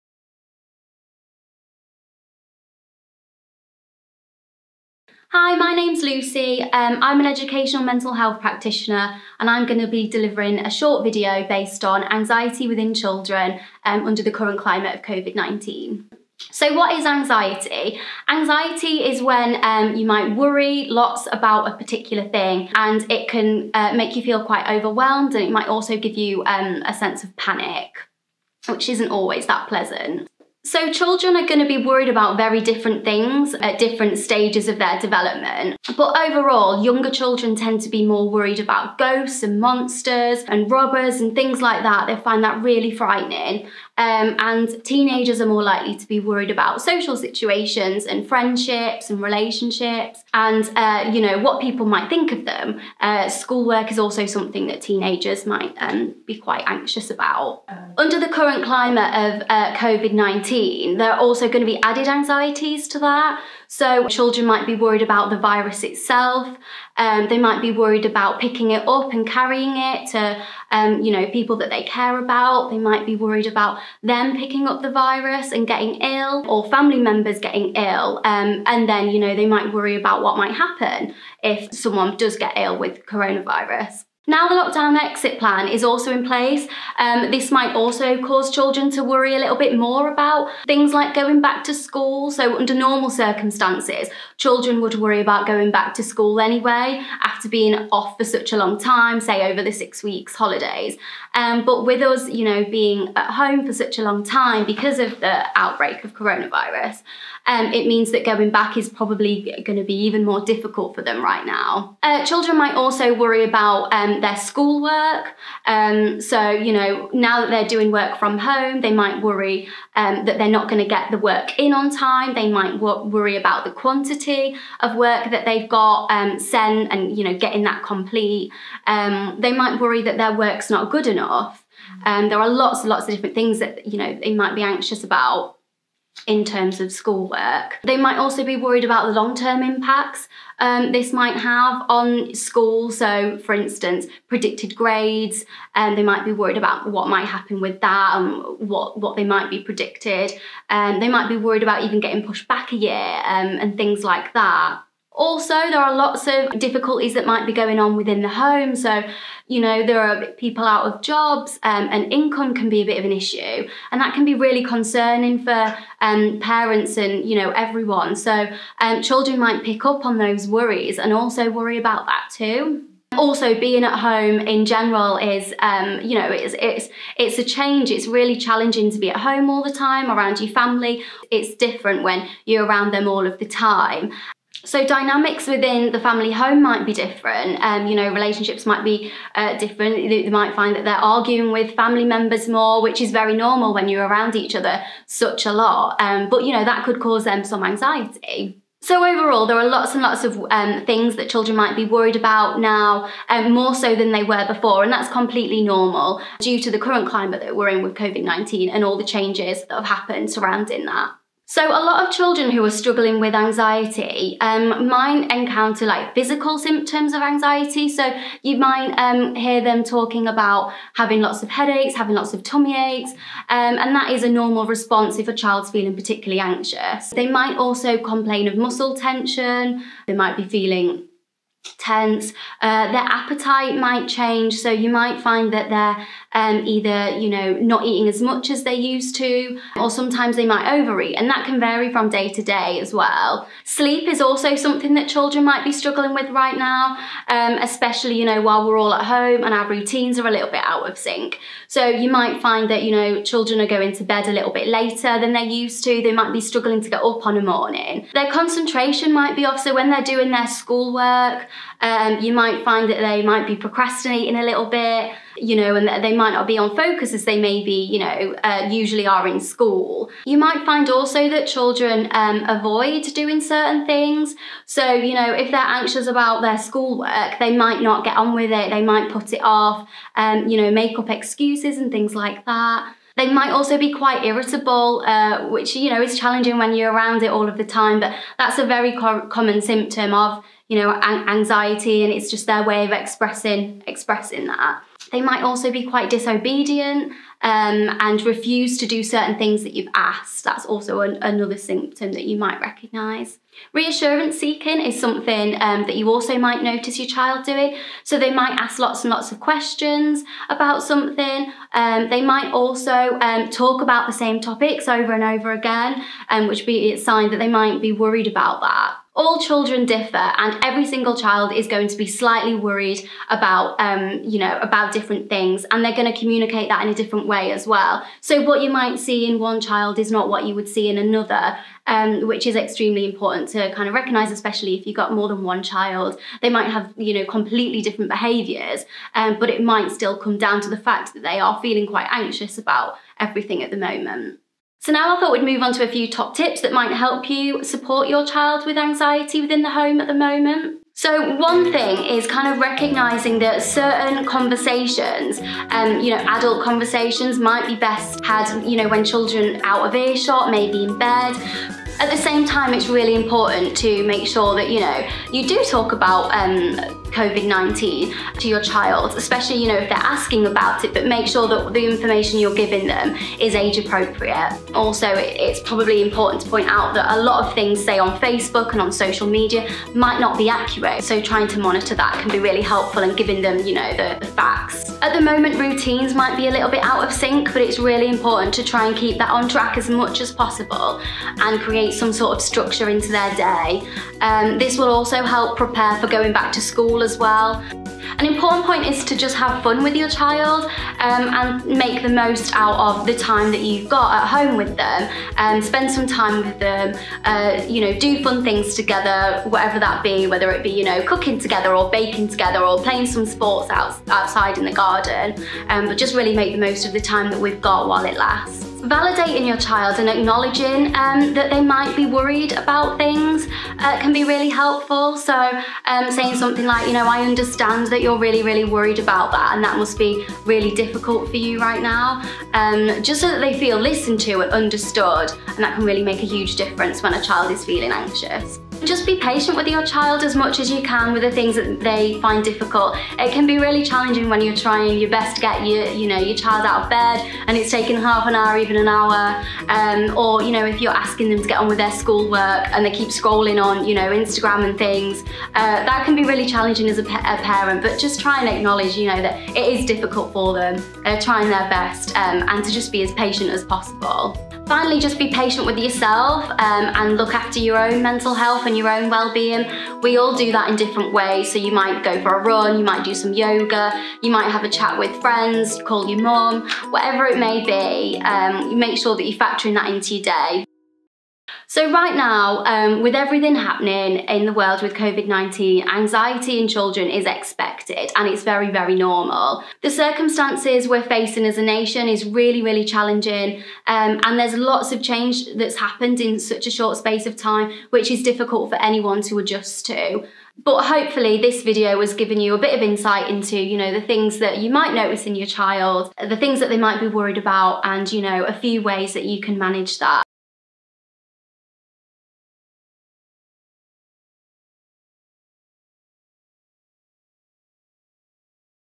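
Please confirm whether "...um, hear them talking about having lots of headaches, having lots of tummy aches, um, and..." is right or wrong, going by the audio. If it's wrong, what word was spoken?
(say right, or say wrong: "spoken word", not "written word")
right.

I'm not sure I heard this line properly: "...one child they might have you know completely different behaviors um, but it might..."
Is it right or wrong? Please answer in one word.
right.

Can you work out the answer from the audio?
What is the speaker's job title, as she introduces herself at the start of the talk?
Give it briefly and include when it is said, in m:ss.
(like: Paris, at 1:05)
educational mental health practitioner, at 0:07.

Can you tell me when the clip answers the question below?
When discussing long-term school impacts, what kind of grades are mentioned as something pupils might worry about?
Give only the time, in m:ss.
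2:24.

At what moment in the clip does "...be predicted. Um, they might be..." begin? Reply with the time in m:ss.
2:29.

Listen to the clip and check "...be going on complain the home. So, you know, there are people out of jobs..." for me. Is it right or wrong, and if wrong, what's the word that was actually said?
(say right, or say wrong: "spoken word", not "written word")
wrong: "within", not "complain".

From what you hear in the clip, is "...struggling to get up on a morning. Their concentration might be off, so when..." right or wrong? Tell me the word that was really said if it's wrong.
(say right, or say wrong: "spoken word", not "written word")
right.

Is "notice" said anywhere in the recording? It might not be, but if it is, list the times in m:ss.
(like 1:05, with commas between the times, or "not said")
5:06, 8:24.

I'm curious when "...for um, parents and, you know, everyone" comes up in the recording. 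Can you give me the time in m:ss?
2:45.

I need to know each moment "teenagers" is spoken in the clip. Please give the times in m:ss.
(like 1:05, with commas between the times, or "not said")
0:44, 0:54.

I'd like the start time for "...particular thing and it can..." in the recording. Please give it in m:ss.
0:21.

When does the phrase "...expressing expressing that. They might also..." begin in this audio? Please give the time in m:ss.
4:52.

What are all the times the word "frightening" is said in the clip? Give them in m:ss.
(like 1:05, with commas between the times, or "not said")
0:42.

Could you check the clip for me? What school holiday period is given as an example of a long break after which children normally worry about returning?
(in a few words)
six weeks holidays.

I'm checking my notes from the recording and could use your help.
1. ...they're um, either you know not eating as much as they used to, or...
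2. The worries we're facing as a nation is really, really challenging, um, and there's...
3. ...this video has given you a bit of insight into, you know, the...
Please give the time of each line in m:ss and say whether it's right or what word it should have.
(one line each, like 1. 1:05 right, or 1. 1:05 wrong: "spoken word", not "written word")
1. 3:55 right
2. 8:09 wrong: "circumstances", not "worries"
3. 8:21 right.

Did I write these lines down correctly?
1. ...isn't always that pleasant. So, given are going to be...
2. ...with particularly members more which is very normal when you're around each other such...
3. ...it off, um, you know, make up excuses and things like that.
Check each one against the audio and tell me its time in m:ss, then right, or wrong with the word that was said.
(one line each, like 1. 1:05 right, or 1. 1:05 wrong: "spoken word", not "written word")
1. 0:28 wrong: "children", not "given"
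2. 3:11 wrong: "family", not "particularly"
3. 4:39 right.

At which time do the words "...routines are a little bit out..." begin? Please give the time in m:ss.
4:09.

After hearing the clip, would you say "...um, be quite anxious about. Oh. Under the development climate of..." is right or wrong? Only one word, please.
wrong.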